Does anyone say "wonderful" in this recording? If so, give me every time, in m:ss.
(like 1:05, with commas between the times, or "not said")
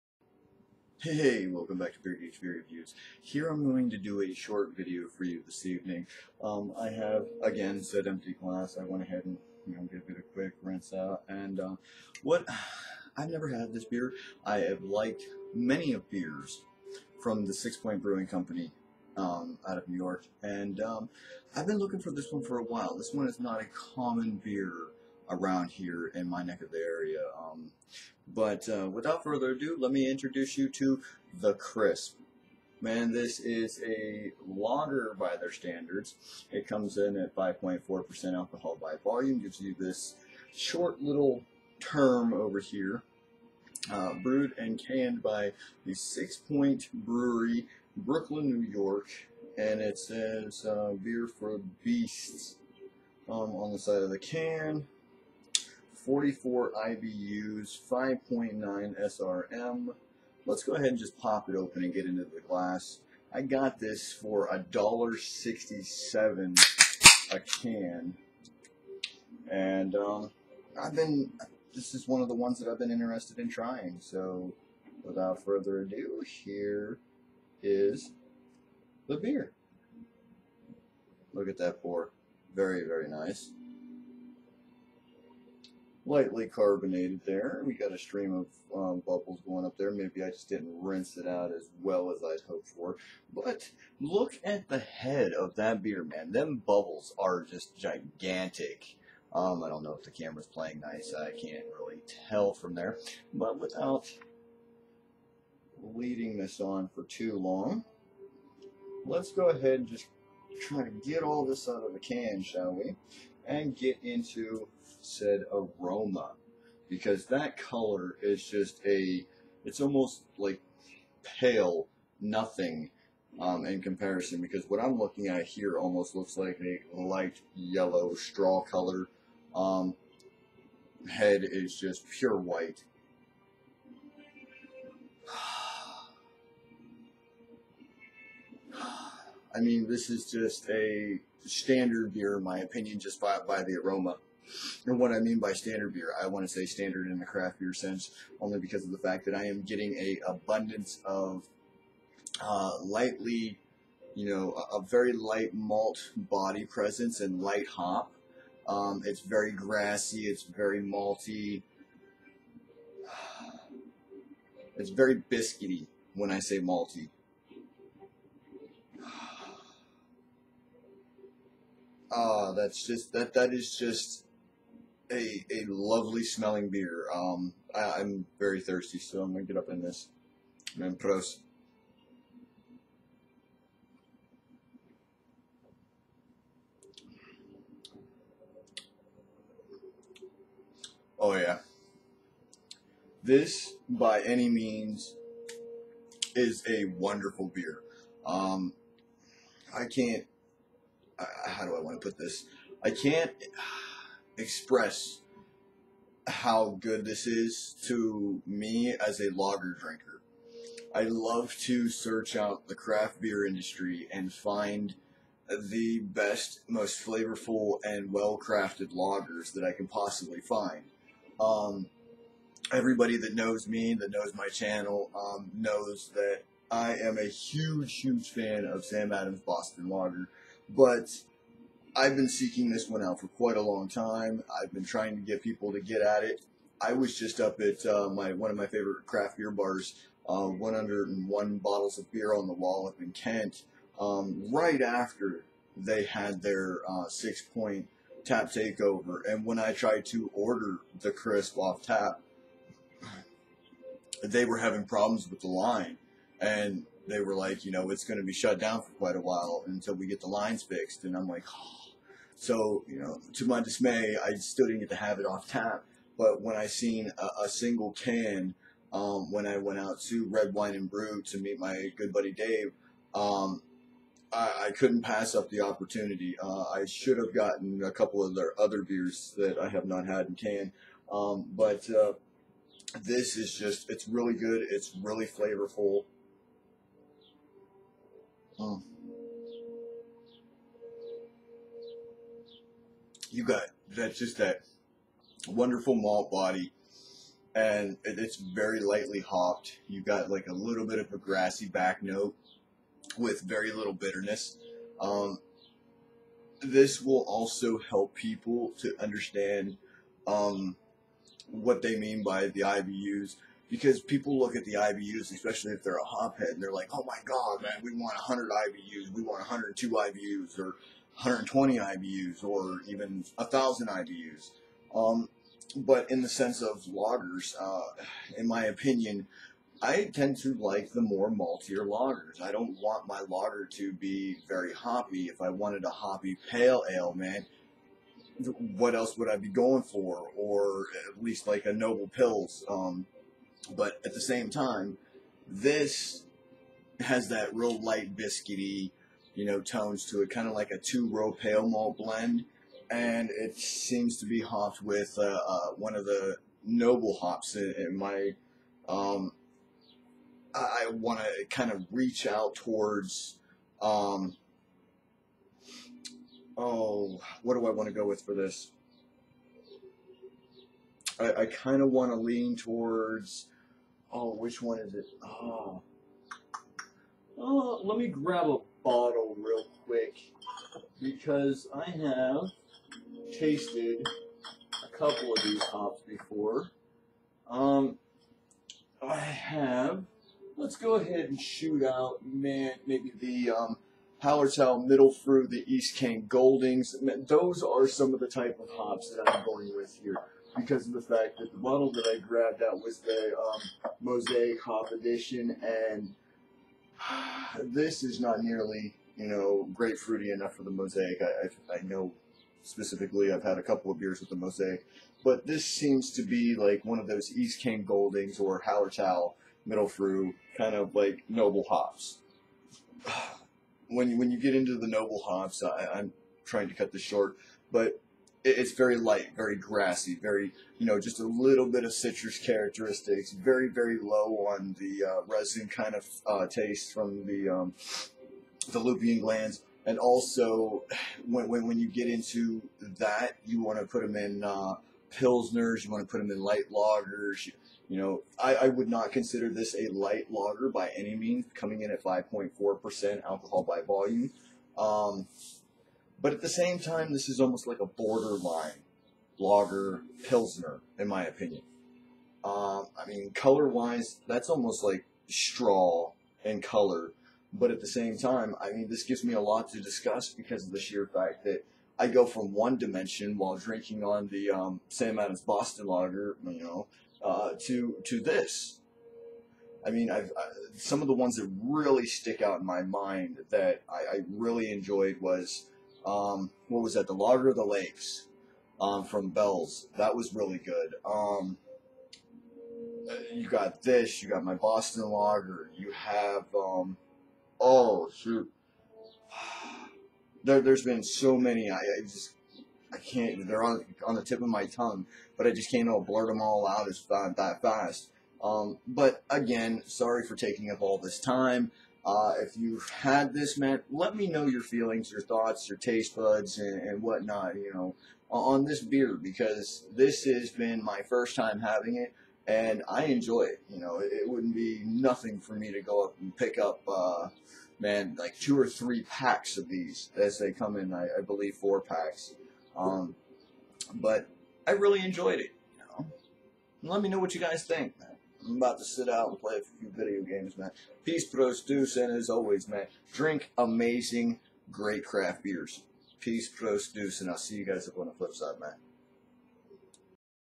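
3:16, 4:55.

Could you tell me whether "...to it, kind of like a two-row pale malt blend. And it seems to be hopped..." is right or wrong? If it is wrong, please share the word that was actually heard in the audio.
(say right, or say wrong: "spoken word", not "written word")
right.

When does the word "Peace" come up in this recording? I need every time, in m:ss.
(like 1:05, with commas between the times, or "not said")
9:01, 9:06.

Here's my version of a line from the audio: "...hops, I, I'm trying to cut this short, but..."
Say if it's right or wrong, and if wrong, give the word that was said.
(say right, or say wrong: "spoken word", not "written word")
right.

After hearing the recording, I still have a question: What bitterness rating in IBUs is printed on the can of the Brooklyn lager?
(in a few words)
44.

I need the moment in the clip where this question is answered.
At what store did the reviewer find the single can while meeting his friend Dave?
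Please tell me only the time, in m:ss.
4:30.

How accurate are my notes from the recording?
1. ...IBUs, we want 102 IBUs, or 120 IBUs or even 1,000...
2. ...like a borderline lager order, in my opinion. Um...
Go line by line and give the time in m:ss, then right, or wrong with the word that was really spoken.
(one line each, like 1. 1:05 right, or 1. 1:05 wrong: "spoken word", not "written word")
1. 5:18 right
2. 7:37 wrong: "pilsner", not "order".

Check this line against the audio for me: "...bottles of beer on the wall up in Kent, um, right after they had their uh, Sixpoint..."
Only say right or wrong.
right.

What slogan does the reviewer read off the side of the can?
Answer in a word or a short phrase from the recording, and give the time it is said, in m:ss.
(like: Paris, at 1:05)
beer for beasts, at 0:51.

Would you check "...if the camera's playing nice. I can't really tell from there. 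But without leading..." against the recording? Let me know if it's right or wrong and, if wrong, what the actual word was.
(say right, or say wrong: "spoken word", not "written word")
right.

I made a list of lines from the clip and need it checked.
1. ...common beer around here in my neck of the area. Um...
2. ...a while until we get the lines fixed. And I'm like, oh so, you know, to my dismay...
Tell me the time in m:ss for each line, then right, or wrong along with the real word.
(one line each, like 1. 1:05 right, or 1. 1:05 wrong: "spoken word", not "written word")
1. 0:23 right
2. 4:19 right.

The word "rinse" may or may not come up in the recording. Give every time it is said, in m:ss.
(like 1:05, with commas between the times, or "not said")
0:10, 1:30.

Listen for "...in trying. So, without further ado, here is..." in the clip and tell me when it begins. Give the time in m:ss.
1:13.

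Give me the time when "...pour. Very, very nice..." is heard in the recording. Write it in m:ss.
1:21.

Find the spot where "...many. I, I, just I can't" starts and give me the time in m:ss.
8:21.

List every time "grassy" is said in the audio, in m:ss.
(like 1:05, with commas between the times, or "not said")
2:39, 5:01, 7:09.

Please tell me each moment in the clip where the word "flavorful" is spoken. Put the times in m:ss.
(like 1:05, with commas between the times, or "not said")
3:37, 4:45.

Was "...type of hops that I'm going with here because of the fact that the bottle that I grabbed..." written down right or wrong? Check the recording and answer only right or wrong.
right.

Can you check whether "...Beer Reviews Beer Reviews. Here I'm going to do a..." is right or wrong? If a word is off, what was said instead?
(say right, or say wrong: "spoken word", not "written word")
wrong: "Geek", not "Reviews".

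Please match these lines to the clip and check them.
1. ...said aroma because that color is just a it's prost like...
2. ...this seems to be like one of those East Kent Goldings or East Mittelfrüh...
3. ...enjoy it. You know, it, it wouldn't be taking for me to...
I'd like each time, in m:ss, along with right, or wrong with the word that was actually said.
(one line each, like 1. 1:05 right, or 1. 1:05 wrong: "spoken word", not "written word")
1. 1:55 wrong: "almost", not "prost"
2. 6:55 wrong: "Hallertau", not "East"
3. 8:43 wrong: "nothing", not "taking".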